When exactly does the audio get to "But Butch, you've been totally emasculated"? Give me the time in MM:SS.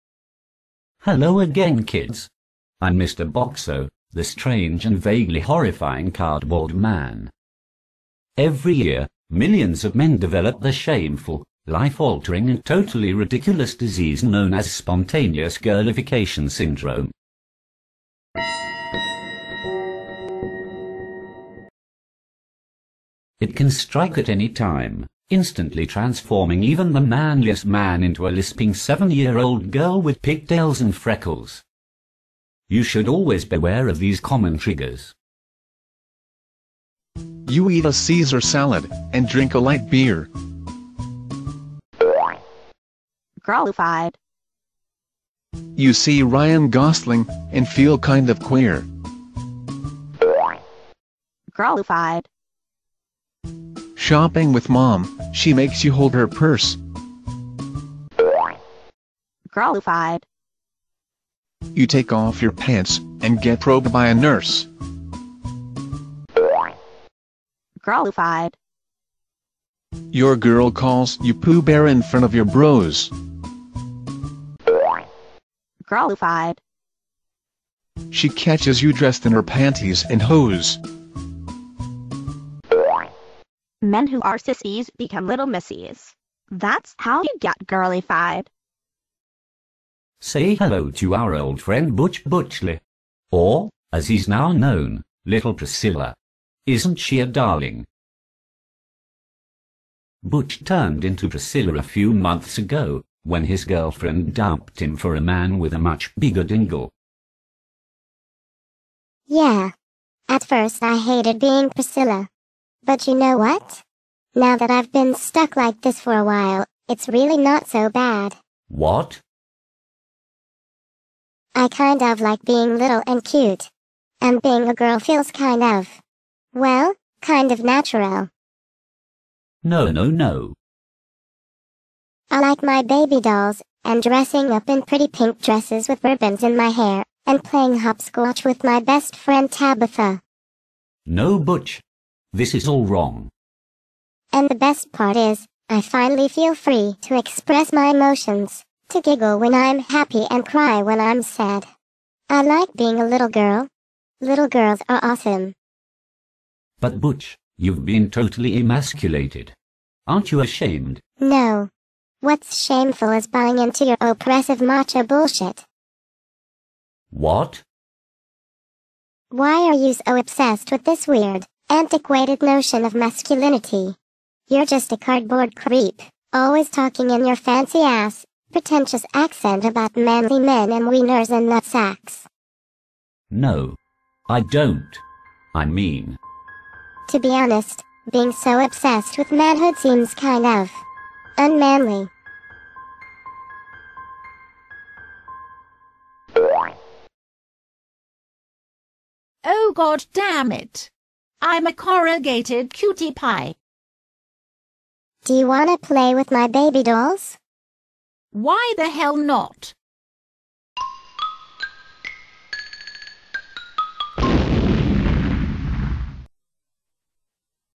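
02:36.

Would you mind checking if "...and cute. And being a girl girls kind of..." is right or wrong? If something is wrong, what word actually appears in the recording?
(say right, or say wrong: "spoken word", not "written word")
wrong: "feels", not "girls".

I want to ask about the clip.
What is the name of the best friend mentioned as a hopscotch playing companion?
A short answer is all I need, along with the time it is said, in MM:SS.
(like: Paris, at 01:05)
Tabitha, at 02:19.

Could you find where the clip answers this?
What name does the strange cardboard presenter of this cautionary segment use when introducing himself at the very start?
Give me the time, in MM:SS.
00:02.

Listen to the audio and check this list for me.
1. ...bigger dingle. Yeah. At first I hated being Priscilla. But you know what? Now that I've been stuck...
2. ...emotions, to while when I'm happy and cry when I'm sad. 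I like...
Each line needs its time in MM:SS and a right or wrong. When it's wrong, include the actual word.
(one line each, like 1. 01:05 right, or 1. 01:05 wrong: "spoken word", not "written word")
1. 01:46 right
2. 02:27 wrong: "giggle", not "while".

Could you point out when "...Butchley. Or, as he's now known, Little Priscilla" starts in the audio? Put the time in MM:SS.
01:32.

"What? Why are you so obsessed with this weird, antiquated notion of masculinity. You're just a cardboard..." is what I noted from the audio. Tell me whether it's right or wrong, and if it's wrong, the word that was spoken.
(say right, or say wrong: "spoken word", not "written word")
right.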